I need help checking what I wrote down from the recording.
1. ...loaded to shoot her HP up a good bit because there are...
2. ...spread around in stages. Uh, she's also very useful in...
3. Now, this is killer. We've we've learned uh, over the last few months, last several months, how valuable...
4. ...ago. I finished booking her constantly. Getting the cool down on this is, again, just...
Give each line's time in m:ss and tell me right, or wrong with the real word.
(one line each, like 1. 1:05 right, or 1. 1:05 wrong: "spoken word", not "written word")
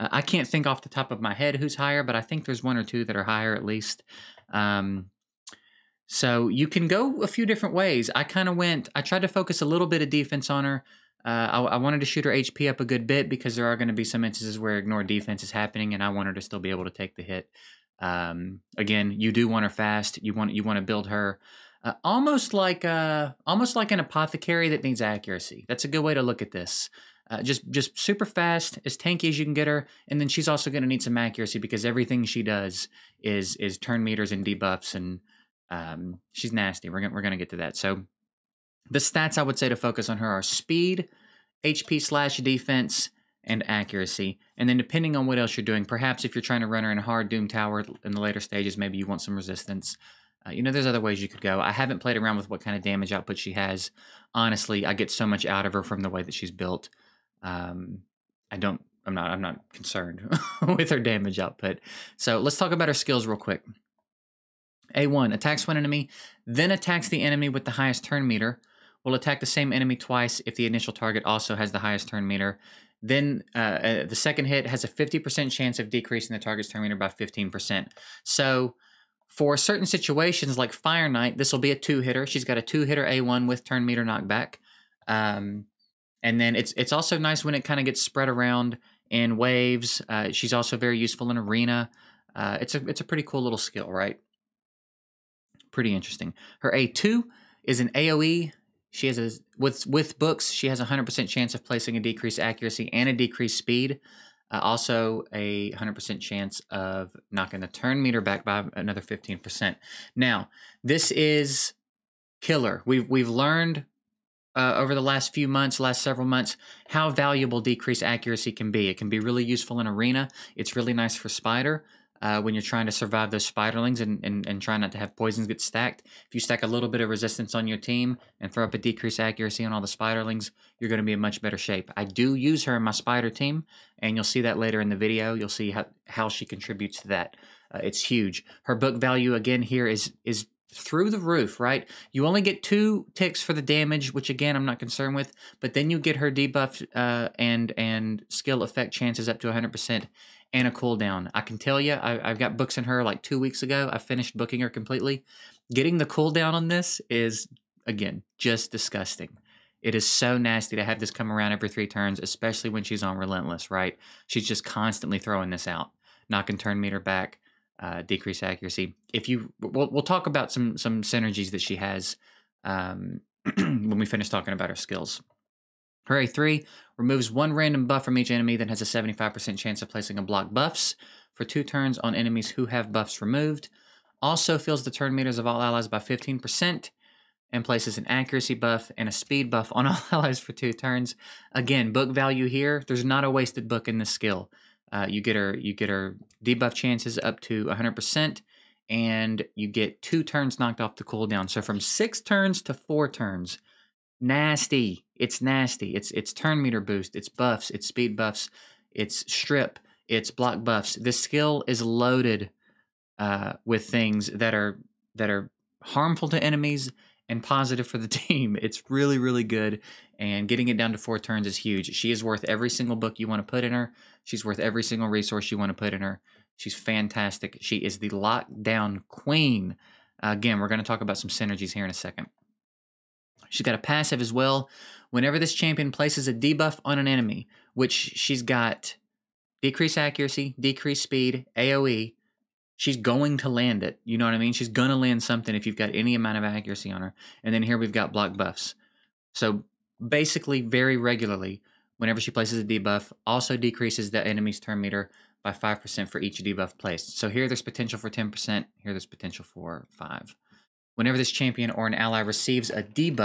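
1. 0:11 wrong: "wanted", not "loaded"
2. 1:28 wrong: "waves", not "stages"
3. 1:50 right
4. 2:33 wrong: "completely", not "constantly".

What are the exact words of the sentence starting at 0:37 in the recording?
So the stats I would say to focus on her are speed, HP slash defense, and accuracy.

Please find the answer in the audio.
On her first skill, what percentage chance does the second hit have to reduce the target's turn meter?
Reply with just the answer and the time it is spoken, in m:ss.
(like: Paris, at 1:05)
50%, at 1:14.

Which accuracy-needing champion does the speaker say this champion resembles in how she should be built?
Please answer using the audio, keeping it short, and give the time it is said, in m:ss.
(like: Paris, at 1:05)
Apothecary, at 0:23.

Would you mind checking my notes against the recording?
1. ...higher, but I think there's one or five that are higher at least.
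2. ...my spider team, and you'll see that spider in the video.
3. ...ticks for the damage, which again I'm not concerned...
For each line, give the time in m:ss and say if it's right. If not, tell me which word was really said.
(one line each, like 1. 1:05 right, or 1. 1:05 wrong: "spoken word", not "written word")
1. 0:01 wrong: "two", not "five"
2. 2:12 wrong: "later", not "spider"
3. 2:23 right.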